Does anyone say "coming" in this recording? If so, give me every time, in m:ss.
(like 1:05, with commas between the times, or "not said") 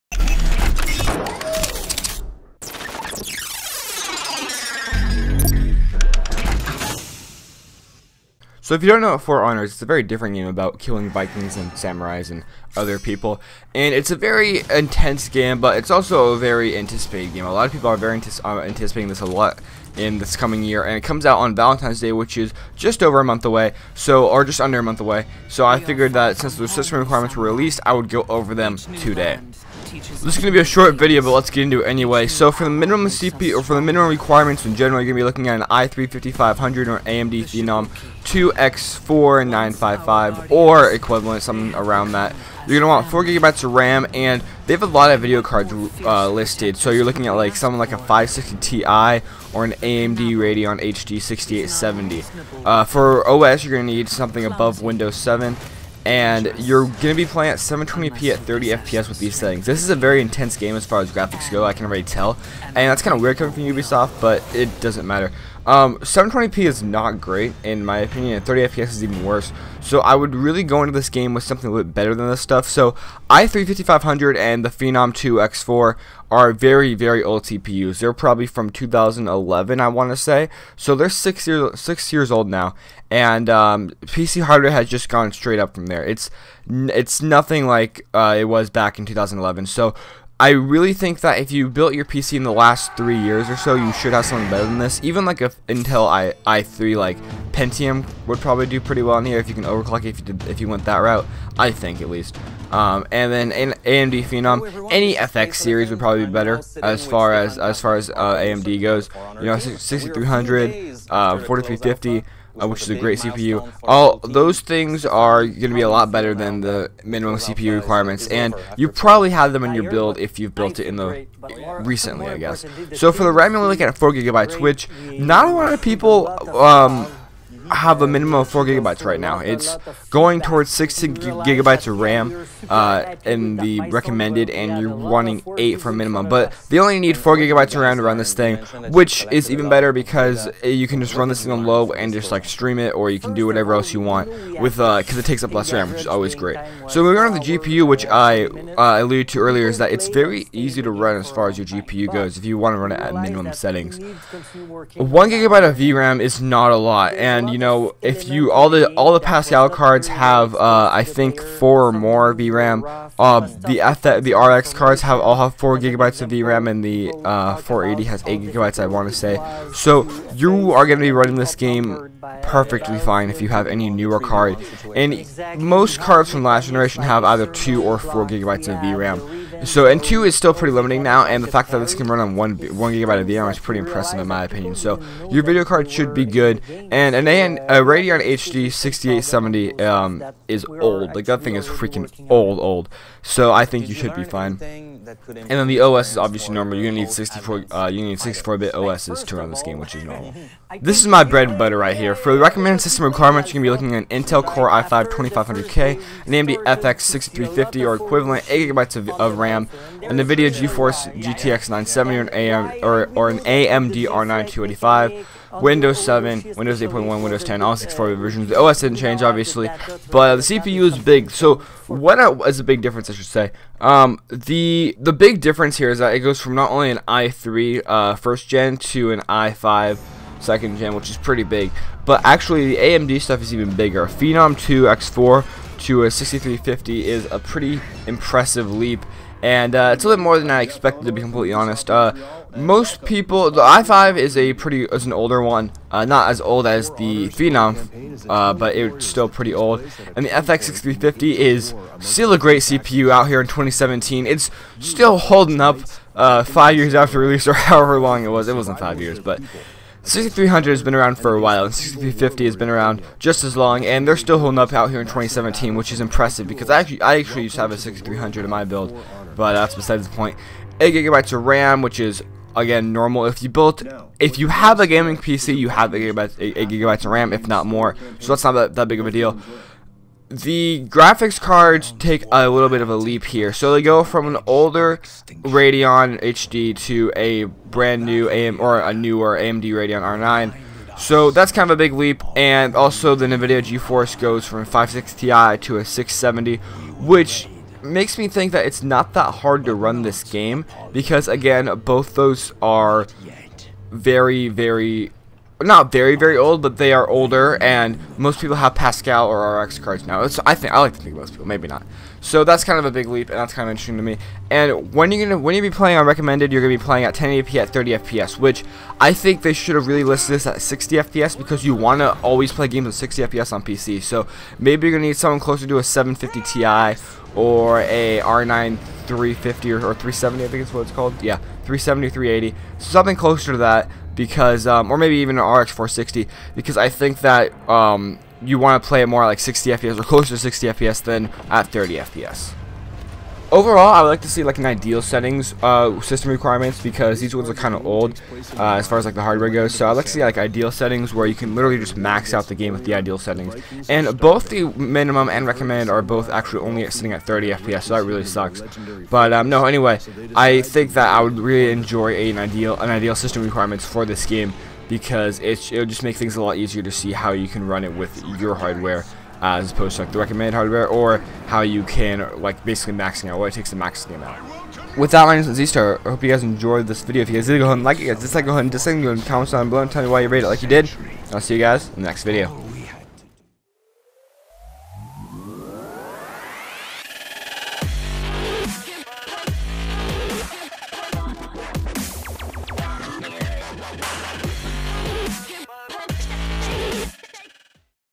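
0:20, 1:03.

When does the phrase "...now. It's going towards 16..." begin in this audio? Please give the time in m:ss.
2:09.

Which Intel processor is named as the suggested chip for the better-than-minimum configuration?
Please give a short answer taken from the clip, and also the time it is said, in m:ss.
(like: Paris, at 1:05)
Core i5 2500K, at 3:24.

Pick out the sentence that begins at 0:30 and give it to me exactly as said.
This is going to be a short video, but let's get into it anyway.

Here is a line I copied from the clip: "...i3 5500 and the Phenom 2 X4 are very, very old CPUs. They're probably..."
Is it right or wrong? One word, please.
right.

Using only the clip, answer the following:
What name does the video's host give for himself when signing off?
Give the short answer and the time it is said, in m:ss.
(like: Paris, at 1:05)
Z-Star, at 6:15.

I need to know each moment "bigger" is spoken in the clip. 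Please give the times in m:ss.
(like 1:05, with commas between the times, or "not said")
3:53.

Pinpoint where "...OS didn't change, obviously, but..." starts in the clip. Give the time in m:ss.
3:38.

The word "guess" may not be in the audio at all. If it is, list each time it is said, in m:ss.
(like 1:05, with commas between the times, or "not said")
2:02.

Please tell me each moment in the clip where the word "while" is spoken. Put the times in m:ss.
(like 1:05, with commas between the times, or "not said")
4:21.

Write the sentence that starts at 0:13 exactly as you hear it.
And it's a very intense game, but it's also a very anticipated game.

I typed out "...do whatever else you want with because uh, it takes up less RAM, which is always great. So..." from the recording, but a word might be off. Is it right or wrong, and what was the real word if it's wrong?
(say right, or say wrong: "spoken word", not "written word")
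right.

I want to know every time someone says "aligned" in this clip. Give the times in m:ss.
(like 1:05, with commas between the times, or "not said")
not said.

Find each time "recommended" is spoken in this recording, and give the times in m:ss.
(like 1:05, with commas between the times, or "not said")
2:13, 3:22, 5:16, 5:55, 6:10.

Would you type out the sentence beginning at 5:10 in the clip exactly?
It's, I think I like to think most people, maybe not.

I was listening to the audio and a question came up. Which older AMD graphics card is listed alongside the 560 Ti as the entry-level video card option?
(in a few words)
Radeon HD 6870.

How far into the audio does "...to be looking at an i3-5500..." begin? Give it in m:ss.
0:35.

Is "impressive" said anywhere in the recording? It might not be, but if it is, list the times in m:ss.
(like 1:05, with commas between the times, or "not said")
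3:03, 3:58, 4:26.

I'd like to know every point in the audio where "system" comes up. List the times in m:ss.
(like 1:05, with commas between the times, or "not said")
0:26, 3:22, 5:46, 6:03.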